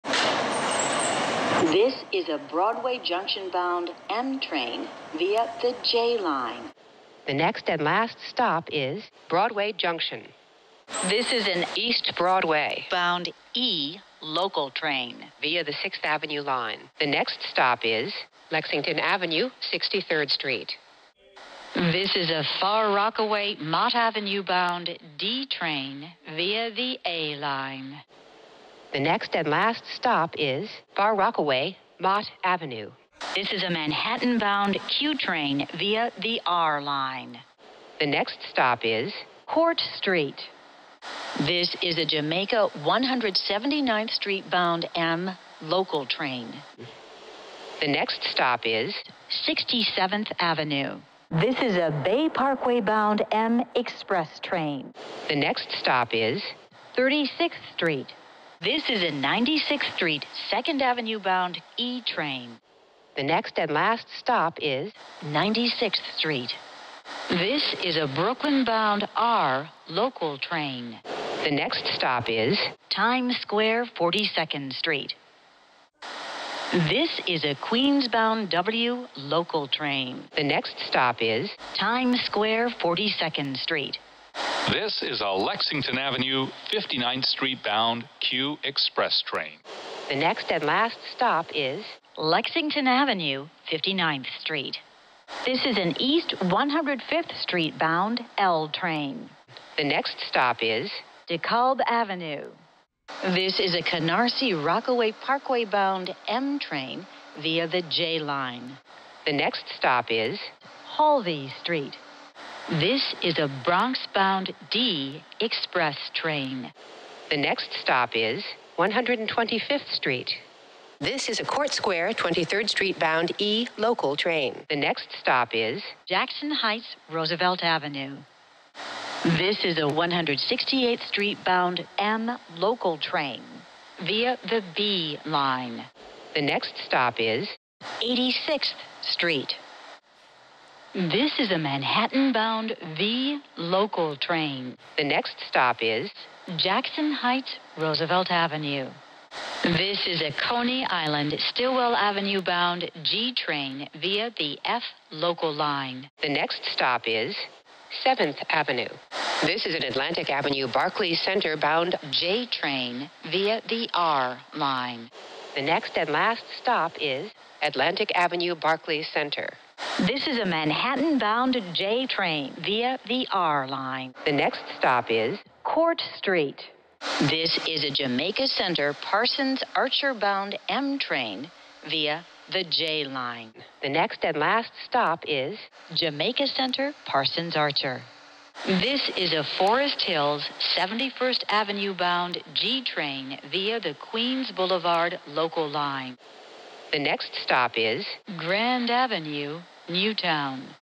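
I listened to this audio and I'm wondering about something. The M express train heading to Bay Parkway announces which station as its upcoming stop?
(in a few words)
36th Street.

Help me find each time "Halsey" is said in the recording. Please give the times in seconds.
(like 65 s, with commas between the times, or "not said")
110 s.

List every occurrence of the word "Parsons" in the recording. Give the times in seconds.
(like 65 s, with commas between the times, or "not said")
178 s, 187 s.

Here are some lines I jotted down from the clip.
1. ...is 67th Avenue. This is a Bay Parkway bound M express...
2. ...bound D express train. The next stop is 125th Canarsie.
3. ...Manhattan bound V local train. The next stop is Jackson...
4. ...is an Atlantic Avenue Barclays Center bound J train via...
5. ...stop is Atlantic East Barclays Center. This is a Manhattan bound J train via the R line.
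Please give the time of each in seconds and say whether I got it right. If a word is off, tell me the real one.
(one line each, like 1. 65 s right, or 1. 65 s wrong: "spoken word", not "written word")
1. 48 s right
2. 114 s wrong: "Street", not "Canarsie"
3. 141 s right
4. 159 s right
5. 166 s wrong: "Avenue", not "East".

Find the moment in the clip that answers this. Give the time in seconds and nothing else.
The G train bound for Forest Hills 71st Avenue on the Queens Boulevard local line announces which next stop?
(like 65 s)
198 s.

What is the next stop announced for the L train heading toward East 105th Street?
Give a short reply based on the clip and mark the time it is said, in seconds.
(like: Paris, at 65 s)
DeKalb Avenue, at 101 s.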